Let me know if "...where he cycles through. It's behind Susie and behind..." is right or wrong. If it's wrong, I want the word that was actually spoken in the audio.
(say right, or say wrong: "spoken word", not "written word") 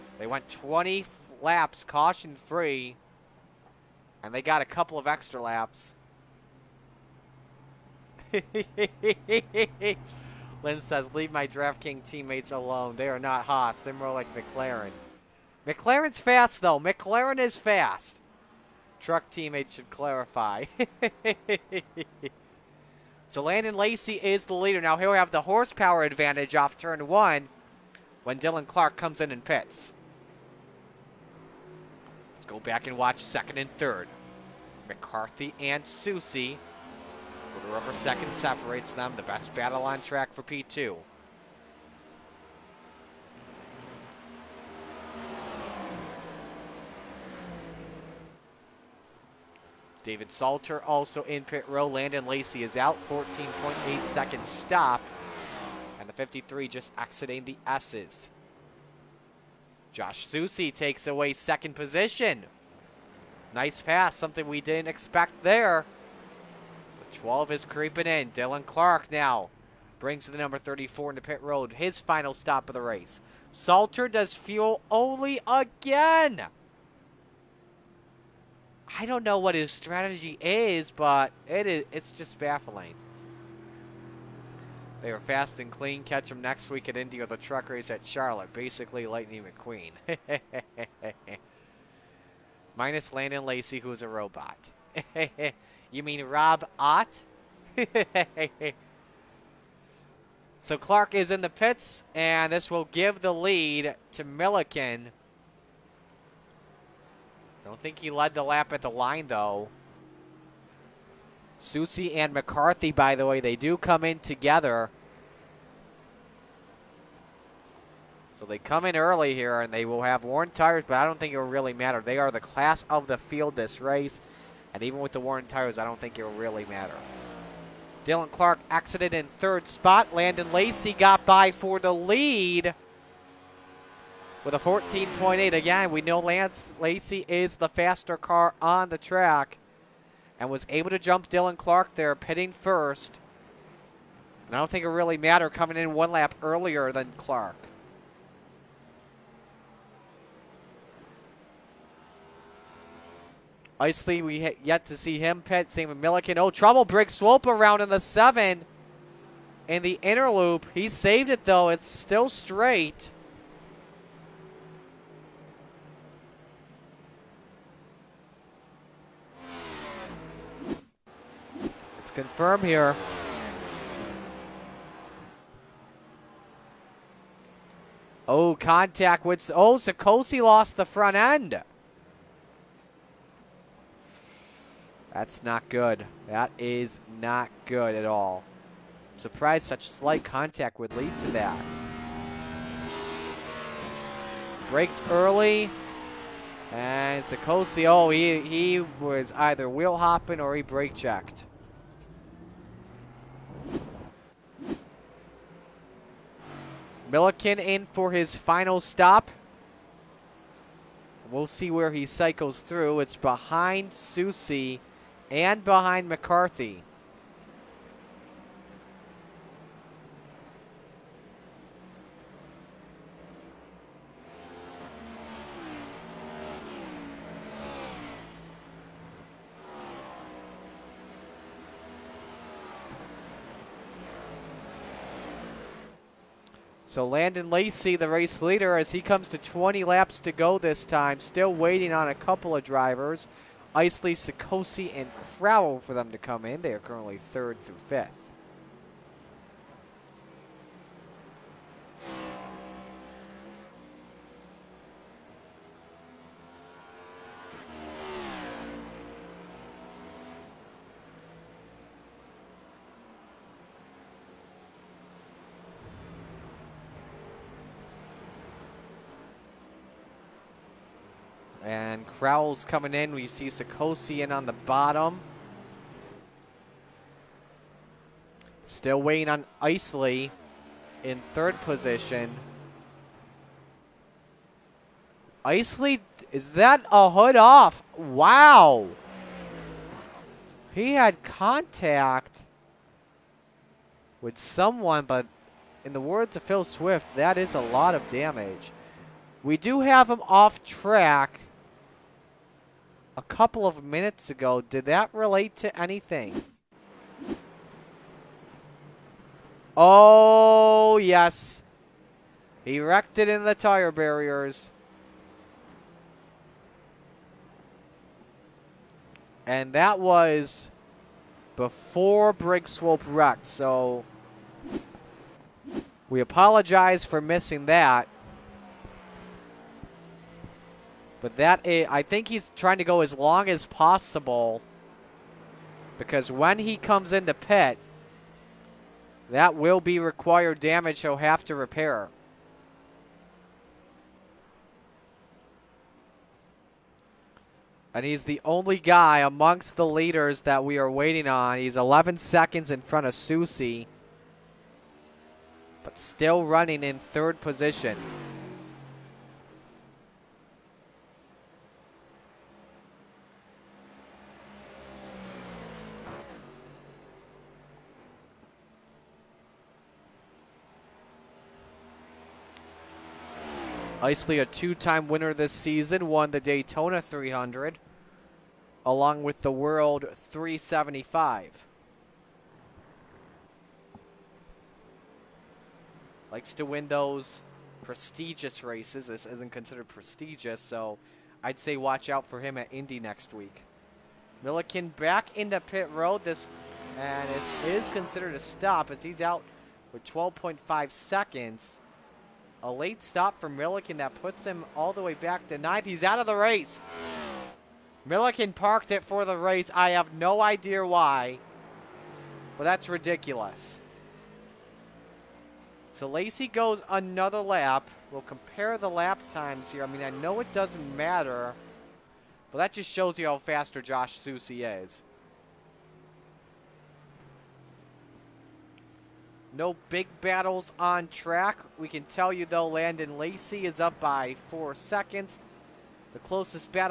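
right.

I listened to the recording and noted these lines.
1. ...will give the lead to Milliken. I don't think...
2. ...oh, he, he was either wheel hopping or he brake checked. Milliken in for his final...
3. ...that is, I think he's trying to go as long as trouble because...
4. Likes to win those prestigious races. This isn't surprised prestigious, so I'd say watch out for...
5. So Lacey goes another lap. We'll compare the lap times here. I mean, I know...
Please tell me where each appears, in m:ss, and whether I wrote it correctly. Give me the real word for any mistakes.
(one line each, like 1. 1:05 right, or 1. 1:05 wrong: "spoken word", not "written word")
1. 1:42 right
2. 3:17 right
3. 5:31 wrong: "possible", not "trouble"
4. 6:26 wrong: "considered", not "surprised"
5. 6:55 right.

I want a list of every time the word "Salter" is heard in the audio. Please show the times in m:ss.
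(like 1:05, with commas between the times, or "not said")
0:50, 1:13.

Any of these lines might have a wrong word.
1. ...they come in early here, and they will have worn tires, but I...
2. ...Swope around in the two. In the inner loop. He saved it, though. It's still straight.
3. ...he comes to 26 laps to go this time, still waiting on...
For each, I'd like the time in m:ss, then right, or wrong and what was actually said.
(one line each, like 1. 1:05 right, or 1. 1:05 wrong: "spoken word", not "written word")
1. 1:58 right
2. 2:37 wrong: "seven", not "two"
3. 3:58 wrong: "20", not "26".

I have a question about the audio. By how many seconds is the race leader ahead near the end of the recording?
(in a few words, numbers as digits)
4.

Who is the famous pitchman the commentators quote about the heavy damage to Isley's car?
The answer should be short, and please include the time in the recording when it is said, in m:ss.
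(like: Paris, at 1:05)
Phil Swift, at 4:56.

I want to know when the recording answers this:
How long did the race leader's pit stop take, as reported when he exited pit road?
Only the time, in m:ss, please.
0:53.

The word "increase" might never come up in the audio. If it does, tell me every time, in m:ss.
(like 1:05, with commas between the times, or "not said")
not said.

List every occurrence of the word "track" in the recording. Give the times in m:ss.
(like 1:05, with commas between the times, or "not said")
0:40, 2:18, 5:00, 7:11.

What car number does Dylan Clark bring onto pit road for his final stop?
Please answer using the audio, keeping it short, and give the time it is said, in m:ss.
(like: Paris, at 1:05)
34, at 1:10.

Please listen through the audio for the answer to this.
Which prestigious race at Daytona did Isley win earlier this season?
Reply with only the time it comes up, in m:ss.
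6:16.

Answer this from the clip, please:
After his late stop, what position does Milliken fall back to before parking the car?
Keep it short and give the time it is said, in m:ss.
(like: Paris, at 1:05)
9th, at 6:45.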